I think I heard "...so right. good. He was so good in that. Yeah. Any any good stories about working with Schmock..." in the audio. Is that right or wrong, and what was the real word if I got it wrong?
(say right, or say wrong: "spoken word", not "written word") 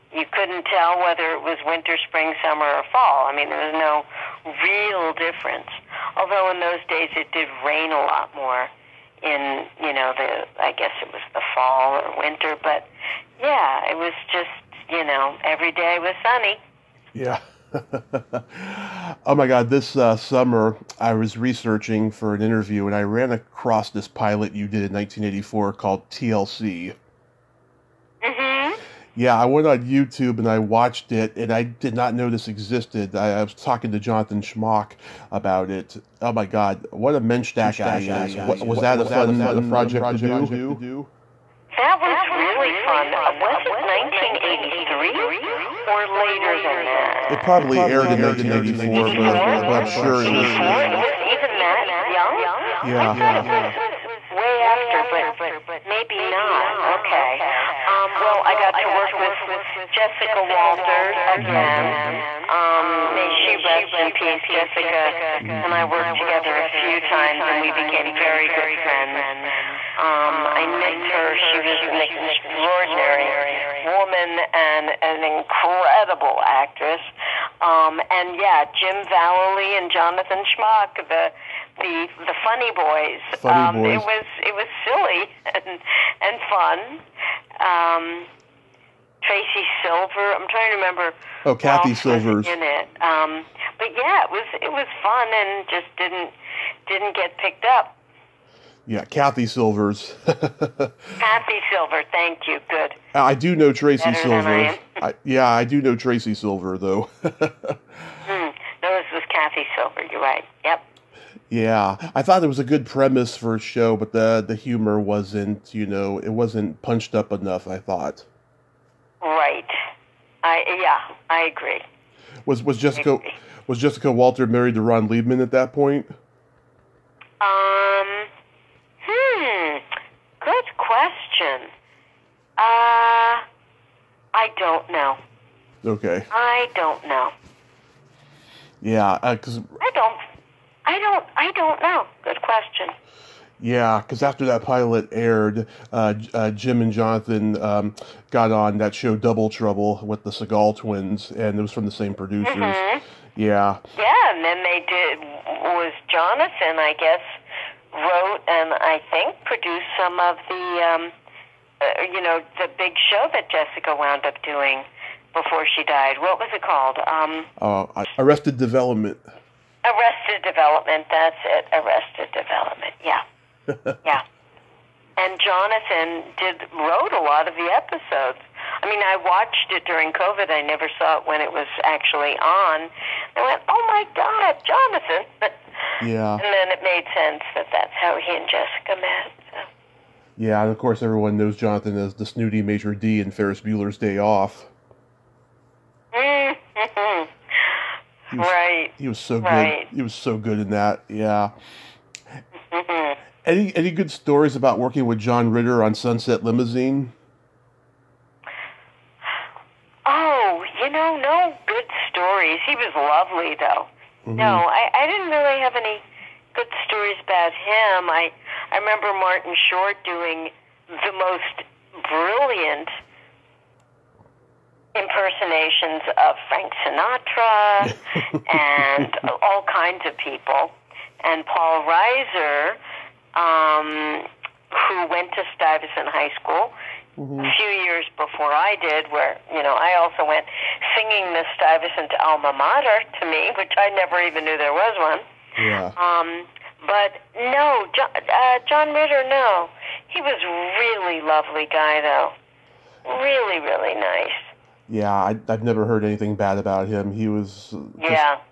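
wrong: "John", not "Schmock".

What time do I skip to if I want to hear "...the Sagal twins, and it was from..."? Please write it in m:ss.
2:30.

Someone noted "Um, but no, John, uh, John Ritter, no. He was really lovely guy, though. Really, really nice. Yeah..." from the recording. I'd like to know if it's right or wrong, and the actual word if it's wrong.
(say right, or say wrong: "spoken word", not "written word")
right.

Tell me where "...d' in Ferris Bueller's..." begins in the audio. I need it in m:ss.
3:12.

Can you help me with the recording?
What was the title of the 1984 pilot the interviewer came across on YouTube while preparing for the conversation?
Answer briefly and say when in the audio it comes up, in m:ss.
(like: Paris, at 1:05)
TLC, at 0:26.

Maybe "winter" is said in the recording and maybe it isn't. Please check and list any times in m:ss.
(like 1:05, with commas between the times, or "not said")
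0:01, 0:12.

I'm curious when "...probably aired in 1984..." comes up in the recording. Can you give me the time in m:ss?
0:47.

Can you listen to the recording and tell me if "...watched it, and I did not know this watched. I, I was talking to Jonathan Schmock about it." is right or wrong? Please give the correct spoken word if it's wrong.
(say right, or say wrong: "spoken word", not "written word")
wrong: "existed", not "watched".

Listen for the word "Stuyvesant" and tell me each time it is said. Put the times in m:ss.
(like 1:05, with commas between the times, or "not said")
3:55, 4:01.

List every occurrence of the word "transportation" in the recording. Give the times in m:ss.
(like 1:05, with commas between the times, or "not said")
not said.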